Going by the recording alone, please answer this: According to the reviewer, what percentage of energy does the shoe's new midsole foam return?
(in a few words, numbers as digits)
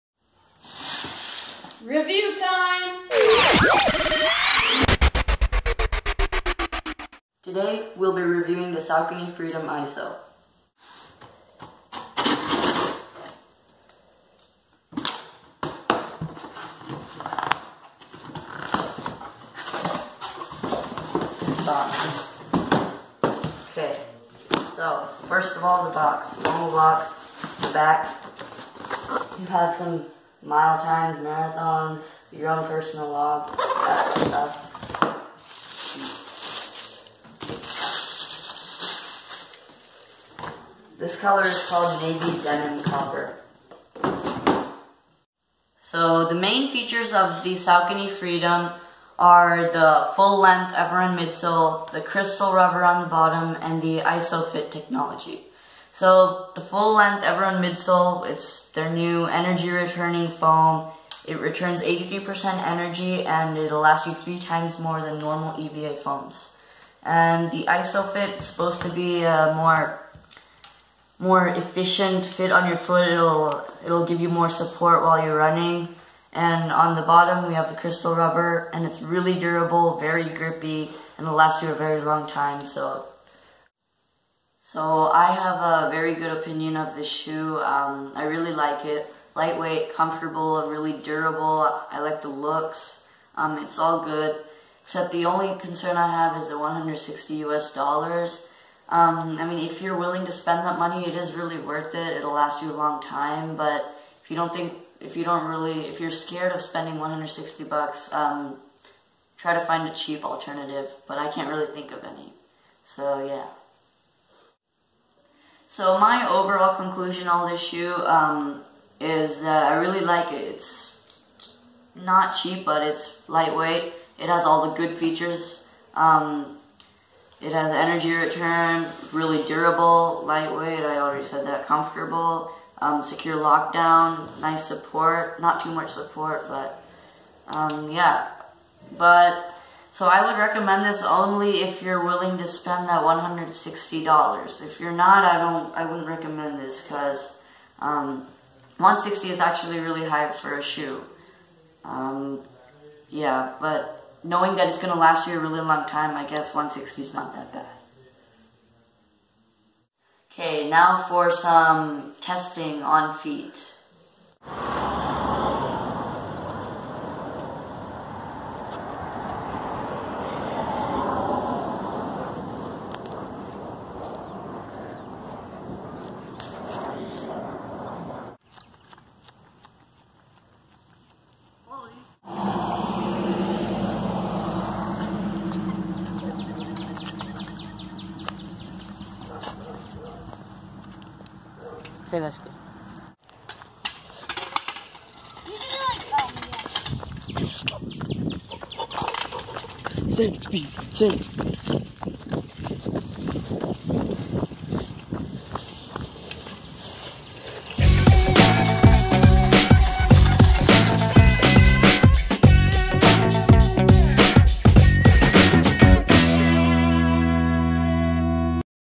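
83%.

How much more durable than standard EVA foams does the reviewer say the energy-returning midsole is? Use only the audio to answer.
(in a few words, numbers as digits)
3 times.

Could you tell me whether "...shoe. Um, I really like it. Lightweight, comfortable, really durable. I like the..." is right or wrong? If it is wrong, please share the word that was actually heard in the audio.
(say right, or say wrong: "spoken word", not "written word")
right.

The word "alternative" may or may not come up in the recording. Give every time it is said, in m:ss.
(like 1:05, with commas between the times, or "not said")
1:50.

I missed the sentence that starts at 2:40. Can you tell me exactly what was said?
Okay, now for some testing on feet.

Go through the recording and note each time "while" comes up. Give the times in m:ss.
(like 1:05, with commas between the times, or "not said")
1:15.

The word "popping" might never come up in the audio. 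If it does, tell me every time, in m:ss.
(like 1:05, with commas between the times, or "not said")
not said.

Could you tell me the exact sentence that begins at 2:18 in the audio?
But so I would recommend this only if you're willing to spend that $160.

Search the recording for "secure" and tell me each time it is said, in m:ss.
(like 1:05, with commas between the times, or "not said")
2:13.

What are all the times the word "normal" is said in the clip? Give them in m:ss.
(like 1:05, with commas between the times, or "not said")
0:26, 1:05.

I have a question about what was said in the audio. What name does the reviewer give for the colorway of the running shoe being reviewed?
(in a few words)
Navy denim copper.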